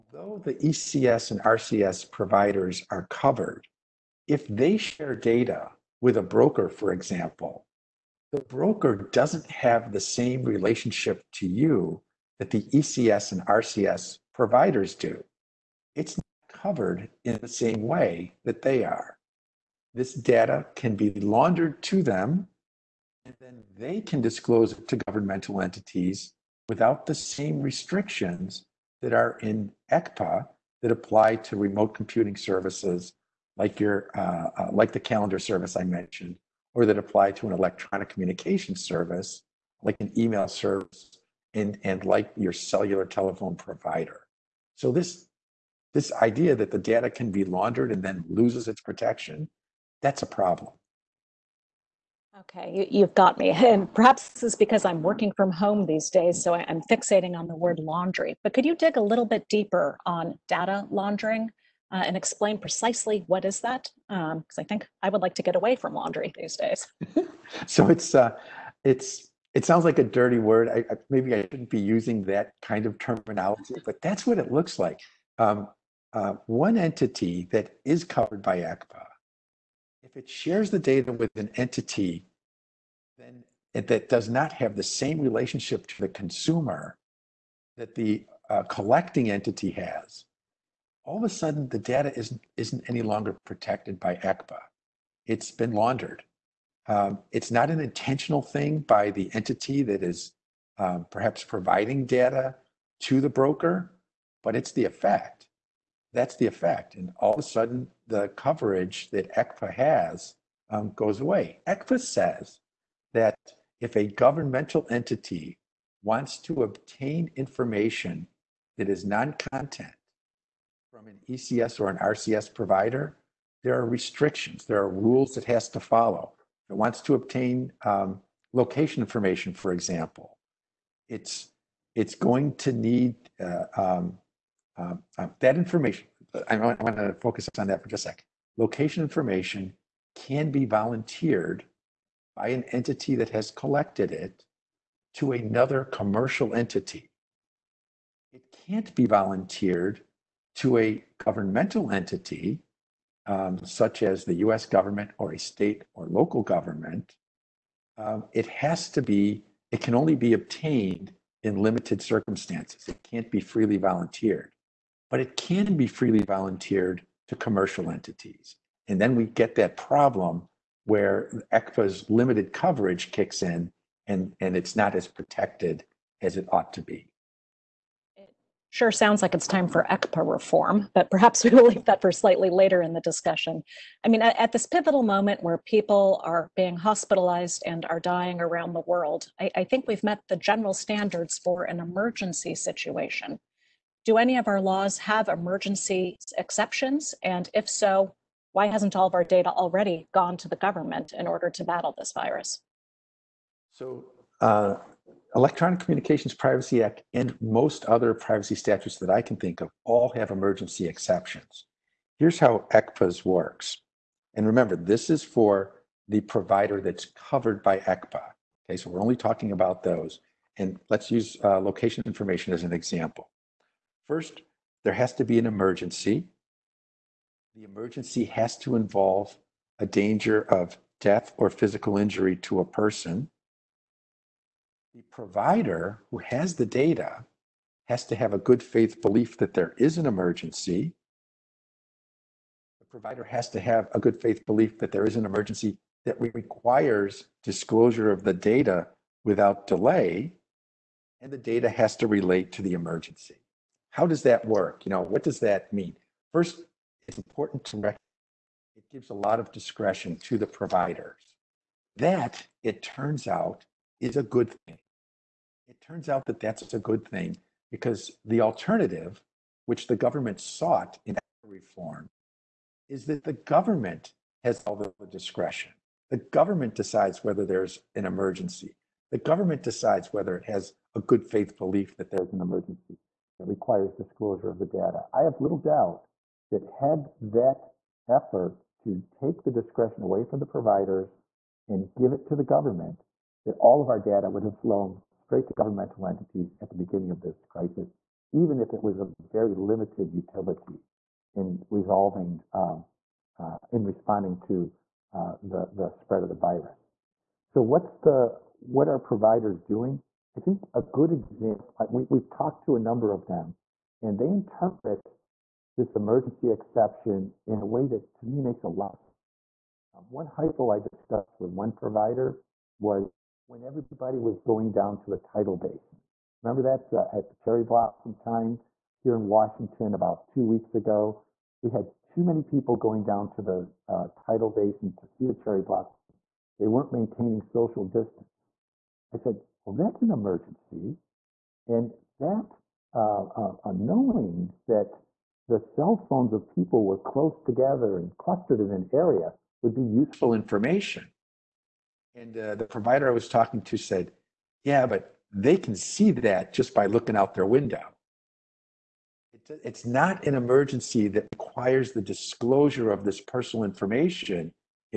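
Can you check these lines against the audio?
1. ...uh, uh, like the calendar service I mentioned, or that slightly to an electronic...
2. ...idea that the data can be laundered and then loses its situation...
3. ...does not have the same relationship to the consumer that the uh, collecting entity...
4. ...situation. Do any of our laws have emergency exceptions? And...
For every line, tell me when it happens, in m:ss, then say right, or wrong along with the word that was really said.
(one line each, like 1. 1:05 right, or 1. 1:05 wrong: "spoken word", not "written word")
1. 0:34 wrong: "apply", not "slightly"
2. 0:46 wrong: "protection", not "situation"
3. 1:24 right
4. 3:12 right.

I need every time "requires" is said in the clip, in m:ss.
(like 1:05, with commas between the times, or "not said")
4:06, 4:43, 6:01.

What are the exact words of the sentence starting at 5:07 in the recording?
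So what's the, what are providers doing?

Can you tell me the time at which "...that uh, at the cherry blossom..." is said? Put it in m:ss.
5:26.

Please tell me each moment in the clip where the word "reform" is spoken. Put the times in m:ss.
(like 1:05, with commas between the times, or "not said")
3:00, 4:31.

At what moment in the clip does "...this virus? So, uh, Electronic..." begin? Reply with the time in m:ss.
3:21.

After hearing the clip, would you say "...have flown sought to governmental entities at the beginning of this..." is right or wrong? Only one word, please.
wrong.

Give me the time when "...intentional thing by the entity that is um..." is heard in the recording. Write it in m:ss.
1:37.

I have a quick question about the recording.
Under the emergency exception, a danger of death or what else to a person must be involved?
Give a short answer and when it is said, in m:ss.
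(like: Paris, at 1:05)
physical injury, at 3:51.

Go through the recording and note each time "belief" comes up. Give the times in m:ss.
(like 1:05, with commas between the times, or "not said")
3:59, 4:04, 4:41.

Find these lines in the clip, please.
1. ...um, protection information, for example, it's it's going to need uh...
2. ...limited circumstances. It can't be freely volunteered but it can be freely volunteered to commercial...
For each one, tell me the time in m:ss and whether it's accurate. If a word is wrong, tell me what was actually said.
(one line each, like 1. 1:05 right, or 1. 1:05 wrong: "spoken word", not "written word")
1. 2:07 wrong: "location", not "protection"
2. 2:41 right.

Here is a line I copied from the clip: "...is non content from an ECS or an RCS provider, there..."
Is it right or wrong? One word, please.
right.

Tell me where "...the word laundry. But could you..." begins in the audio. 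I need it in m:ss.
0:57.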